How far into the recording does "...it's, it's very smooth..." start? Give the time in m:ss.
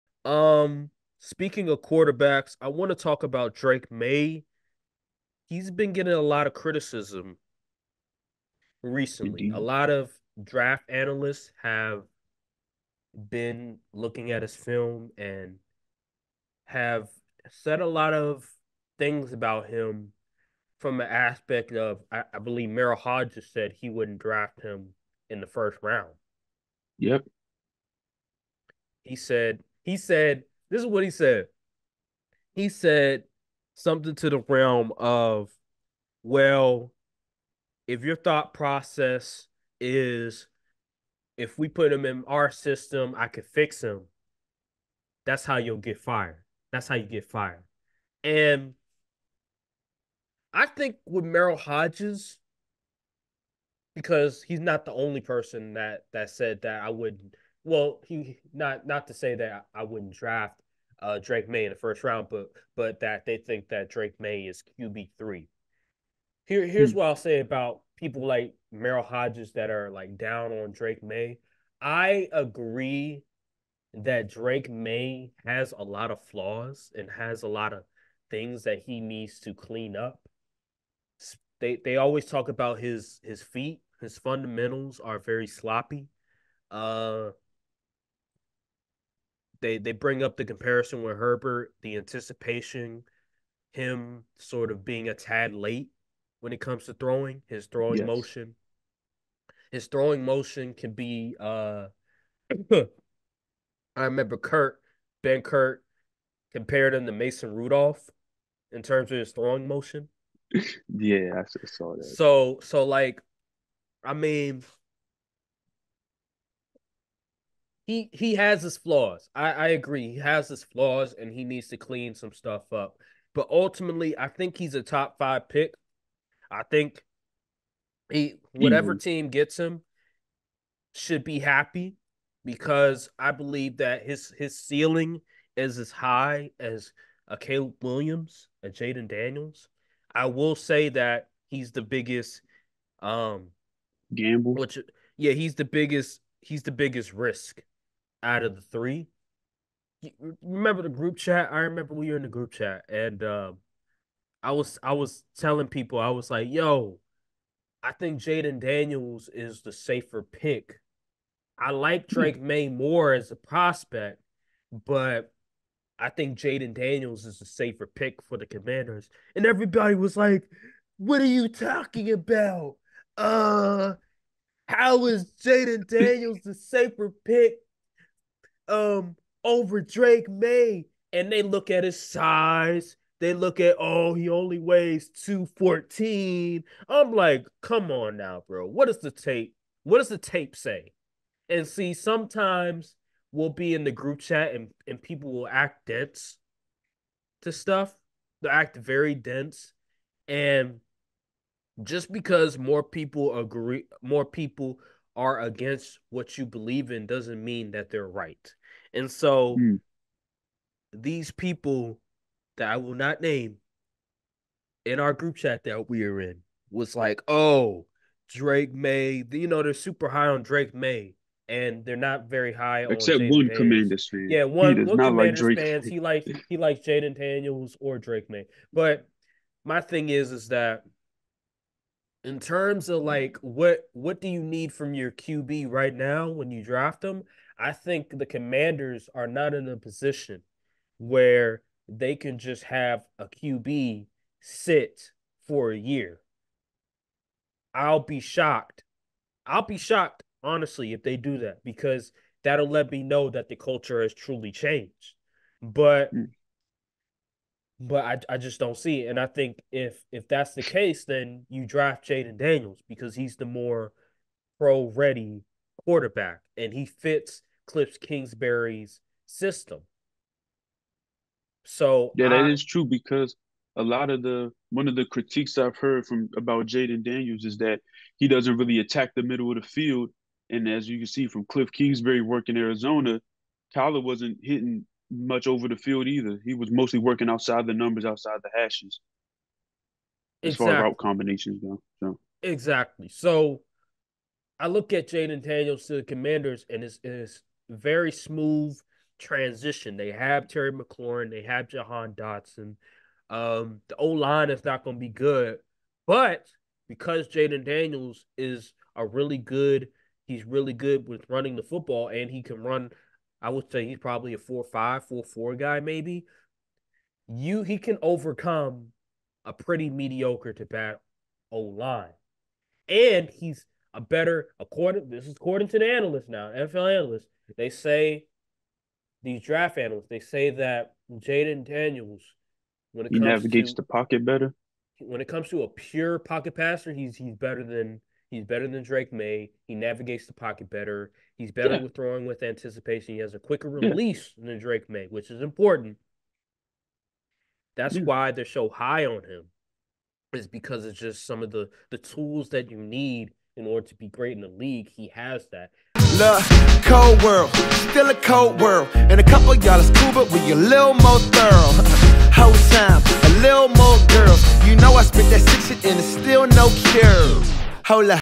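4:56.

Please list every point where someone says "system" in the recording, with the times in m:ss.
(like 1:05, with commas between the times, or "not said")
0:42, 4:29.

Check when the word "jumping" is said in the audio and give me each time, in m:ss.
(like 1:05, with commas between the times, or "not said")
not said.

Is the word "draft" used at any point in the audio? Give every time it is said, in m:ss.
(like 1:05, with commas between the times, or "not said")
0:10, 0:24, 1:00, 3:56, 4:21, 5:29.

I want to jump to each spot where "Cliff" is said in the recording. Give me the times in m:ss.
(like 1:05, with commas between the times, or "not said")
4:27, 4:41.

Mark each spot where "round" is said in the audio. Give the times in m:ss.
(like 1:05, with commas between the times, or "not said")
0:25, 1:02.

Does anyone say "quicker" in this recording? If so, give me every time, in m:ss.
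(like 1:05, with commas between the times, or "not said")
5:43.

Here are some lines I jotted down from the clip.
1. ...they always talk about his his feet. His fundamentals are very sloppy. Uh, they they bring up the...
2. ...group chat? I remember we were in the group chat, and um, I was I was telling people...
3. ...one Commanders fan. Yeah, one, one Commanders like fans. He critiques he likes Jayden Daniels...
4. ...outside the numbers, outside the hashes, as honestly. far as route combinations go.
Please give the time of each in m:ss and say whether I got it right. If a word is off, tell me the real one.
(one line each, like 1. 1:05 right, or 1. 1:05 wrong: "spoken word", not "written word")
1. 1:21 right
2. 2:30 right
3. 3:43 wrong: "likes", not "critiques"
4. 4:47 wrong: "exactly", not "honestly".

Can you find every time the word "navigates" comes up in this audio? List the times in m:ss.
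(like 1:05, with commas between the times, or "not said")
5:33, 5:39.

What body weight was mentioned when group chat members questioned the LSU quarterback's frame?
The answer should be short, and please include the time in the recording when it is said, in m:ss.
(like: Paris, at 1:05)
214, at 3:05.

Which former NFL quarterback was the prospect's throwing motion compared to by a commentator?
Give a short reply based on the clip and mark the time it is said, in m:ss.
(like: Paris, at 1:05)
Mason Rudolph, at 1:47.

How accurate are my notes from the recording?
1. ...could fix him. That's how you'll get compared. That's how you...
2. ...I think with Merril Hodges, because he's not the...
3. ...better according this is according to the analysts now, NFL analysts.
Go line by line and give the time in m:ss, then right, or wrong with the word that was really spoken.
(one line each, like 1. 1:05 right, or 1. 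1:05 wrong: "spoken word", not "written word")
1. 0:43 wrong: "fired", not "compared"
2. 0:50 right
3. 5:24 right.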